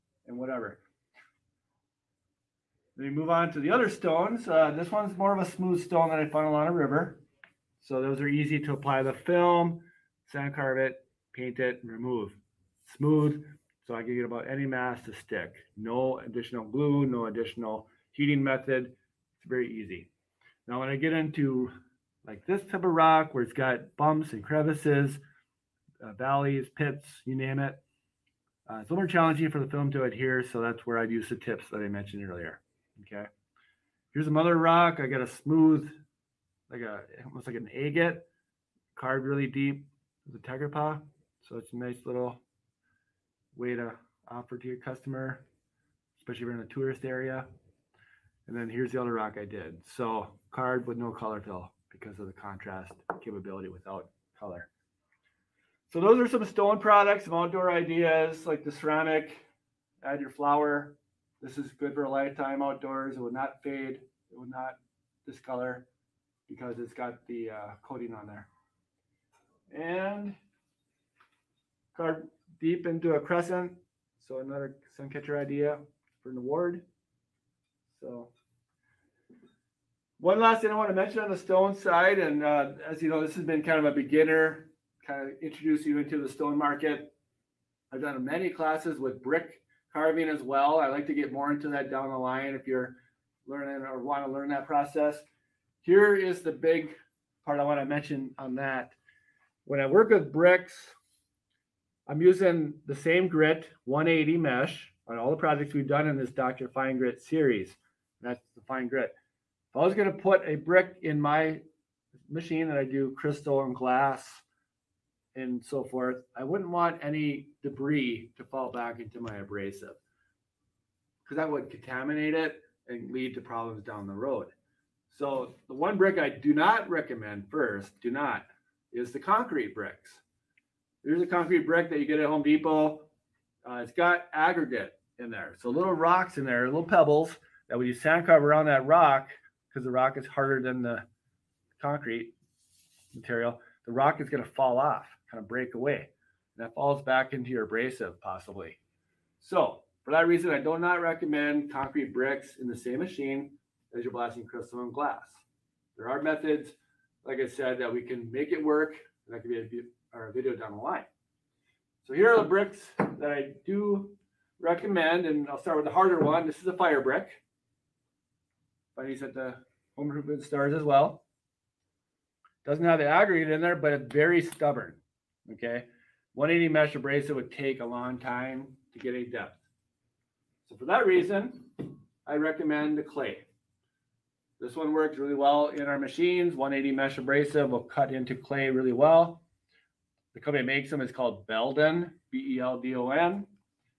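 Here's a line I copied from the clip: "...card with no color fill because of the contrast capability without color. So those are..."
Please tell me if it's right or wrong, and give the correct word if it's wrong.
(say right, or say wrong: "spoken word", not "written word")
right.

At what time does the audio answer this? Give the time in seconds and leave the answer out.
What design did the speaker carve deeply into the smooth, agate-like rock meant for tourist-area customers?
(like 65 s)
40 s.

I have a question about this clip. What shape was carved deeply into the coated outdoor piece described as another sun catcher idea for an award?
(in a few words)
Crescent.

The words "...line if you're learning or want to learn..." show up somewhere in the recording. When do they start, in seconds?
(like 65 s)
92 s.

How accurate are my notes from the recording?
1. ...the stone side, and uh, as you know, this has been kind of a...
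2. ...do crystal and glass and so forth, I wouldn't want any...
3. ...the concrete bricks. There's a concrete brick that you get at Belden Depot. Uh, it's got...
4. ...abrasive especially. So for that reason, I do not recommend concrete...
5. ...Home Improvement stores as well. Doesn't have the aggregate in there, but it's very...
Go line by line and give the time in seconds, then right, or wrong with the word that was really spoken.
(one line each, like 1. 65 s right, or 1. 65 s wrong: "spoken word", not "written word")
1. 81 s right
2. 112 s right
3. 129 s wrong: "Home", not "Belden"
4. 147 s wrong: "possibly", not "especially"
5. 169 s right.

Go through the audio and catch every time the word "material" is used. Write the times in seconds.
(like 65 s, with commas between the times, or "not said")
143 s.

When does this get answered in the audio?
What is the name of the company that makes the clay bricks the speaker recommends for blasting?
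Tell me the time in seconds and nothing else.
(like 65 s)
191 s.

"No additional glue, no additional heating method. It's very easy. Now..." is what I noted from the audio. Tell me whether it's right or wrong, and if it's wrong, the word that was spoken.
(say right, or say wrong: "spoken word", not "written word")
right.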